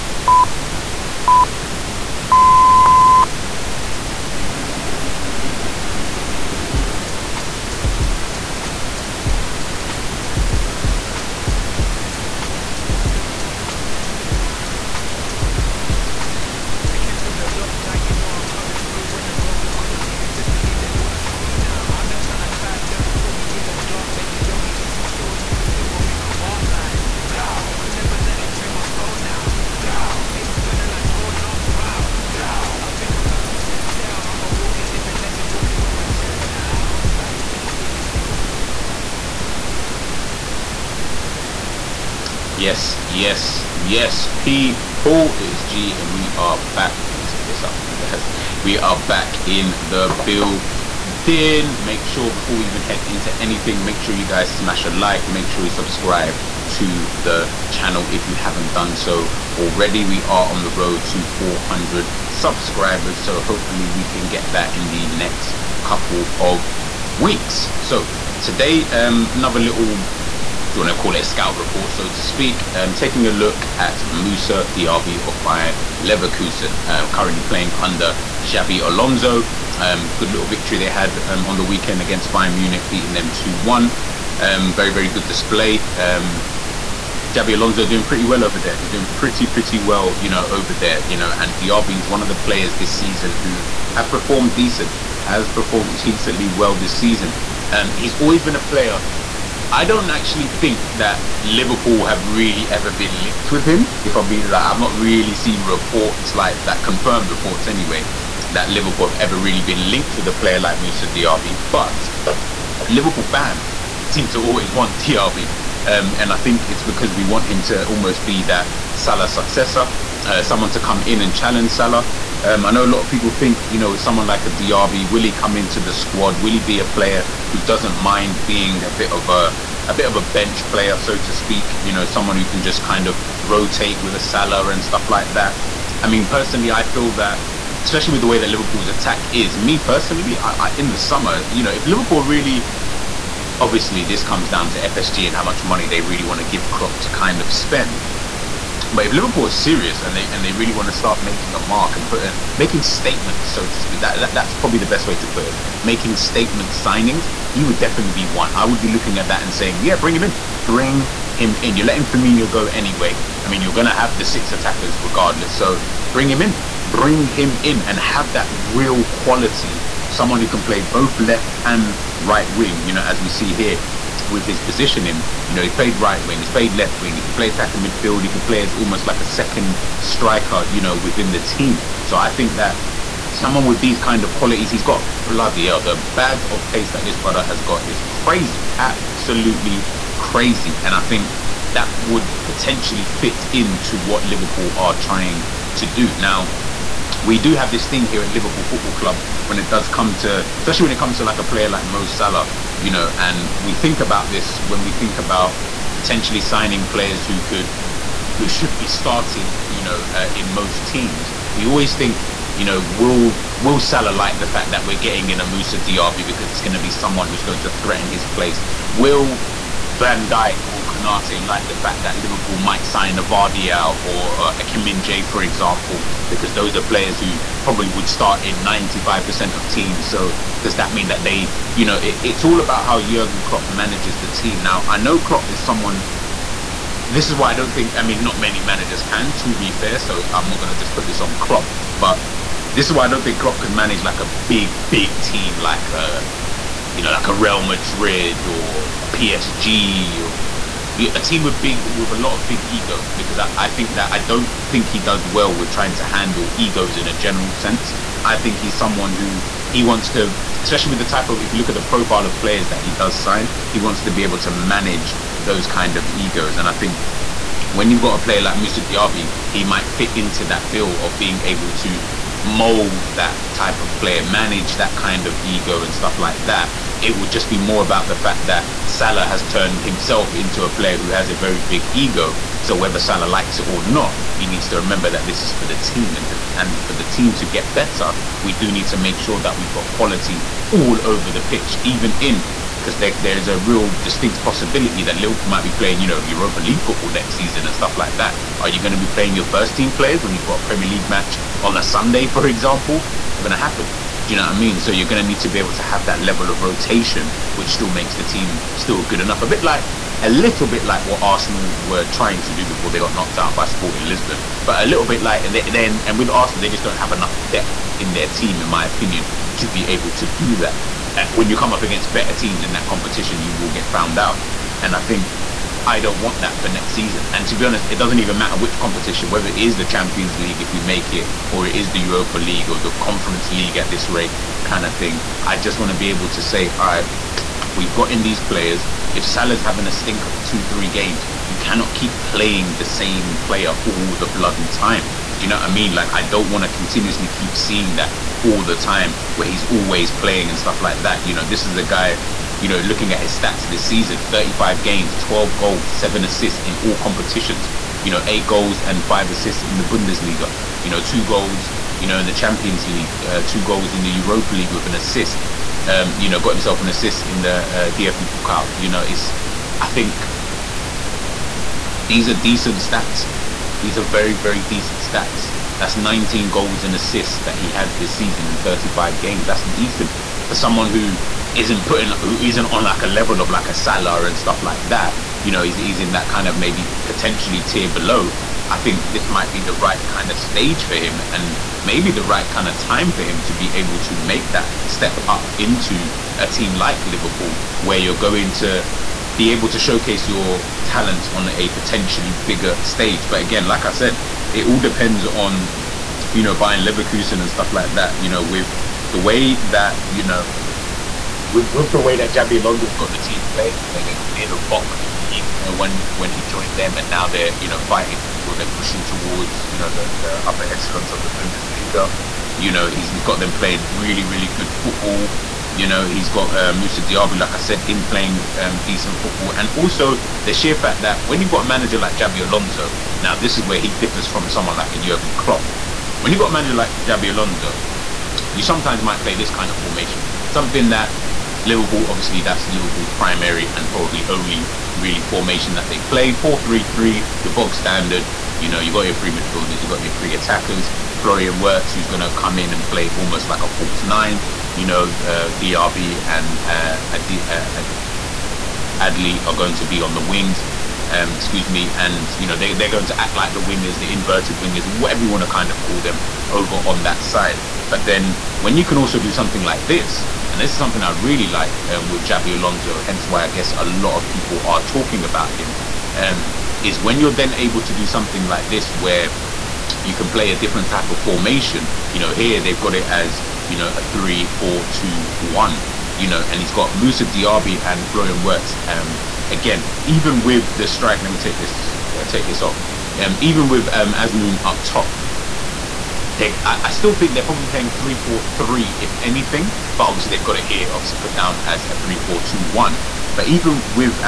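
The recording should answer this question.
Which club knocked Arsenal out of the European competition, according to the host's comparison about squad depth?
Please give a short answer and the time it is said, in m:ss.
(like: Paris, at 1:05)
Sporting Lisbon, at 5:13.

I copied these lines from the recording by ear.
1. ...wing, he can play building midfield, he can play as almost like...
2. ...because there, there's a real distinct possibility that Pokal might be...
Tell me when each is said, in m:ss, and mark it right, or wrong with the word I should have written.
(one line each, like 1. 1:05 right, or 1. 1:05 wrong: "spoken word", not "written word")
1. 2:57 wrong: "attacking", not "building"
2. 4:52 wrong: "Liverpool", not "Pokal".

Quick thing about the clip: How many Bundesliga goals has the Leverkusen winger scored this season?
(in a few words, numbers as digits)
8.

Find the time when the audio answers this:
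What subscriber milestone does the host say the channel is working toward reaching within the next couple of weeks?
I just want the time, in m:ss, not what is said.
1:01.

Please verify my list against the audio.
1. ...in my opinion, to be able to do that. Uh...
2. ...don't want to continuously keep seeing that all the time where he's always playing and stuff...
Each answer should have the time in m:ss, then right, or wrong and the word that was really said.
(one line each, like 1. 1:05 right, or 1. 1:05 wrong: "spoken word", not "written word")
1. 5:18 right
2. 5:46 right.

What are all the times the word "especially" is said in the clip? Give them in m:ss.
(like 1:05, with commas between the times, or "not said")
2:17, 3:20, 4:20.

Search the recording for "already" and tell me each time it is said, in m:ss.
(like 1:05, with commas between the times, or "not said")
0:59.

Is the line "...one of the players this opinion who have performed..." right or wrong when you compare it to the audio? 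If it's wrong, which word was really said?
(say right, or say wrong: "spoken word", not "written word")
wrong: "season", not "opinion".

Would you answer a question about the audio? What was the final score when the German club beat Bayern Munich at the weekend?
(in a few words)
2-1.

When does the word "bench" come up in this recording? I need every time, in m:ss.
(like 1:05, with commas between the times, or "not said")
2:10.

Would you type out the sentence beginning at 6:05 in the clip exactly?
Um, you know, got himself an assist in the uh, DFB Pokal.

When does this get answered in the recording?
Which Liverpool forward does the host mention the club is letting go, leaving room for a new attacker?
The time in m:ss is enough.
2:42.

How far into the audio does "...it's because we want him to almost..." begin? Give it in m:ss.
1:56.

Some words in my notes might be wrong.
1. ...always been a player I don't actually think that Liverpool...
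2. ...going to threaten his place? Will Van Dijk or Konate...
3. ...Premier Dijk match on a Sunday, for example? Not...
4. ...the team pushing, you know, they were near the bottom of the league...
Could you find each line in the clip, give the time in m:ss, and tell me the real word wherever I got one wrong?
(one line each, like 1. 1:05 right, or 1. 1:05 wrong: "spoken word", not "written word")
1. 1:38 right
2. 3:37 right
3. 5:00 wrong: "League", not "Dijk"
4. 6:53 wrong: "playing", not "pushing".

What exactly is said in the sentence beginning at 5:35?
I just want to be able to say, all right, we've got in these players.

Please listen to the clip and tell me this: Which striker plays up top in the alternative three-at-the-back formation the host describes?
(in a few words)
Azmoun.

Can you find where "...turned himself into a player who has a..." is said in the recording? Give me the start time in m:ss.
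4:39.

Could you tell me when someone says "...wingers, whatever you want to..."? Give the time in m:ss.
7:44.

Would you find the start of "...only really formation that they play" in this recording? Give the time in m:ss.
7:24.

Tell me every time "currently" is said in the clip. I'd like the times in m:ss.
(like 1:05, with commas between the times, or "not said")
1:17.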